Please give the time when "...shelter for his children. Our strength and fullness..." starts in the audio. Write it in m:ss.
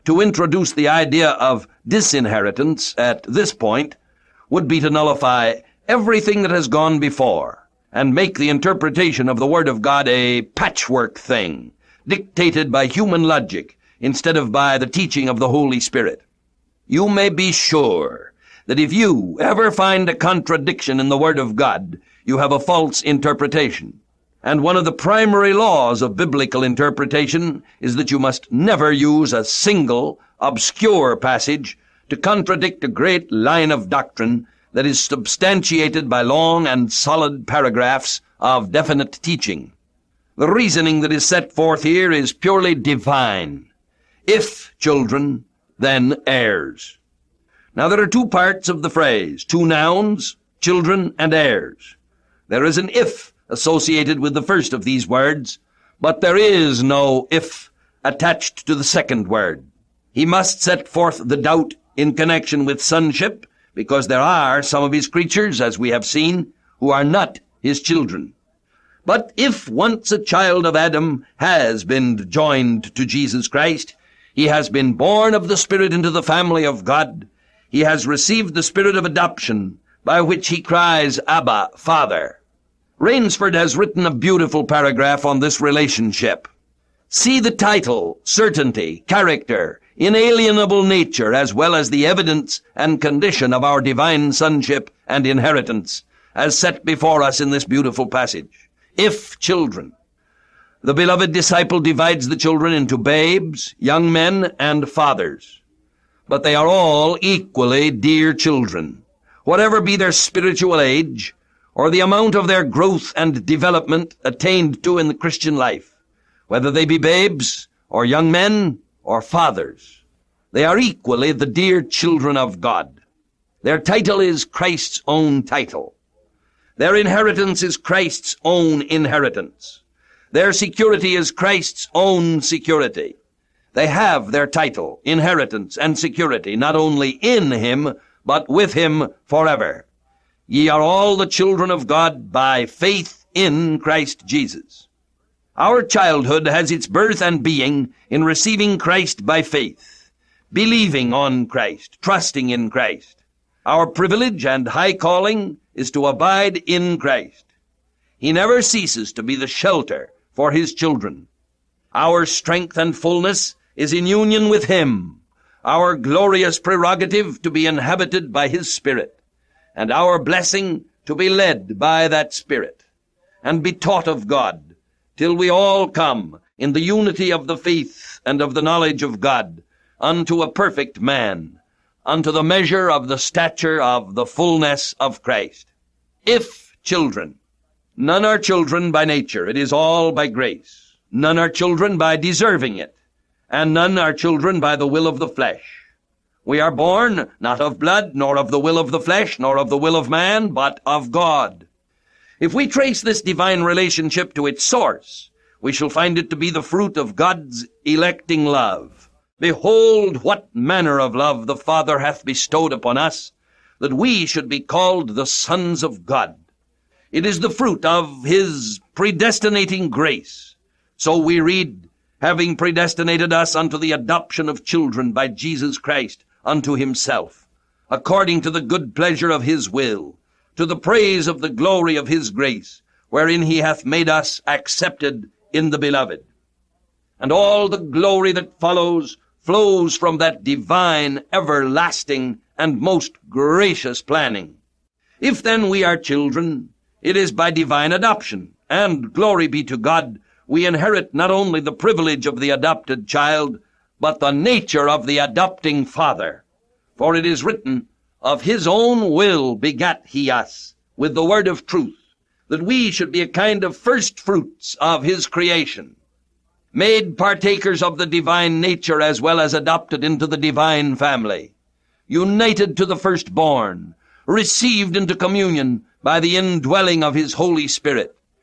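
2:39.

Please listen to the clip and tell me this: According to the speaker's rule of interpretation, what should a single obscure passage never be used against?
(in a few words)
A great line of doctrine.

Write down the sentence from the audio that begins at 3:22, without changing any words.
If we trace this divine relationship to its source, we shall find it to be the fruit of God's electing love.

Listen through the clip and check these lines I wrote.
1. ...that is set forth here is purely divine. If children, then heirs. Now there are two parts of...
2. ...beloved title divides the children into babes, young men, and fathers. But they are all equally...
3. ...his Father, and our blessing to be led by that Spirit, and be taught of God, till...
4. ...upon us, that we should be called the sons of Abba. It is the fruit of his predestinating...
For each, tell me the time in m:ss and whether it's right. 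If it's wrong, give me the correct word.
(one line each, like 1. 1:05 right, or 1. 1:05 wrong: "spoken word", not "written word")
1. 0:41 right
2. 1:40 wrong: "disciple", not "title"
3. 2:48 wrong: "Spirit", not "Father"
4. 3:32 wrong: "God", not "Abba".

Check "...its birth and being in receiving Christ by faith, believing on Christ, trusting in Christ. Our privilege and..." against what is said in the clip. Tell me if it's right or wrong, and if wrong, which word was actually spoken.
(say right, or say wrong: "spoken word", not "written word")
right.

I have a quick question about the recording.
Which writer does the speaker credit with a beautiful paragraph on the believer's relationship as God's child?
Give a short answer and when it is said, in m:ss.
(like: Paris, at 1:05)
Rainsford, at 1:22.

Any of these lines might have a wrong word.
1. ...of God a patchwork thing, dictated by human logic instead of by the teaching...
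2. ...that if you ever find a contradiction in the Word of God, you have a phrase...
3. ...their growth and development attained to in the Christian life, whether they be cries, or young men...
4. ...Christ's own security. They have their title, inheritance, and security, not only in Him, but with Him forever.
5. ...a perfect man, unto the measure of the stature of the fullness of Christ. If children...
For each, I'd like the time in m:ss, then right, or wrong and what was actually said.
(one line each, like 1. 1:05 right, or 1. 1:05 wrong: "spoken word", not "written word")
1. 0:09 right
2. 0:18 wrong: "false", not "phrase"
3. 1:52 wrong: "babes", not "cries"
4. 2:11 right
5. 3:00 right.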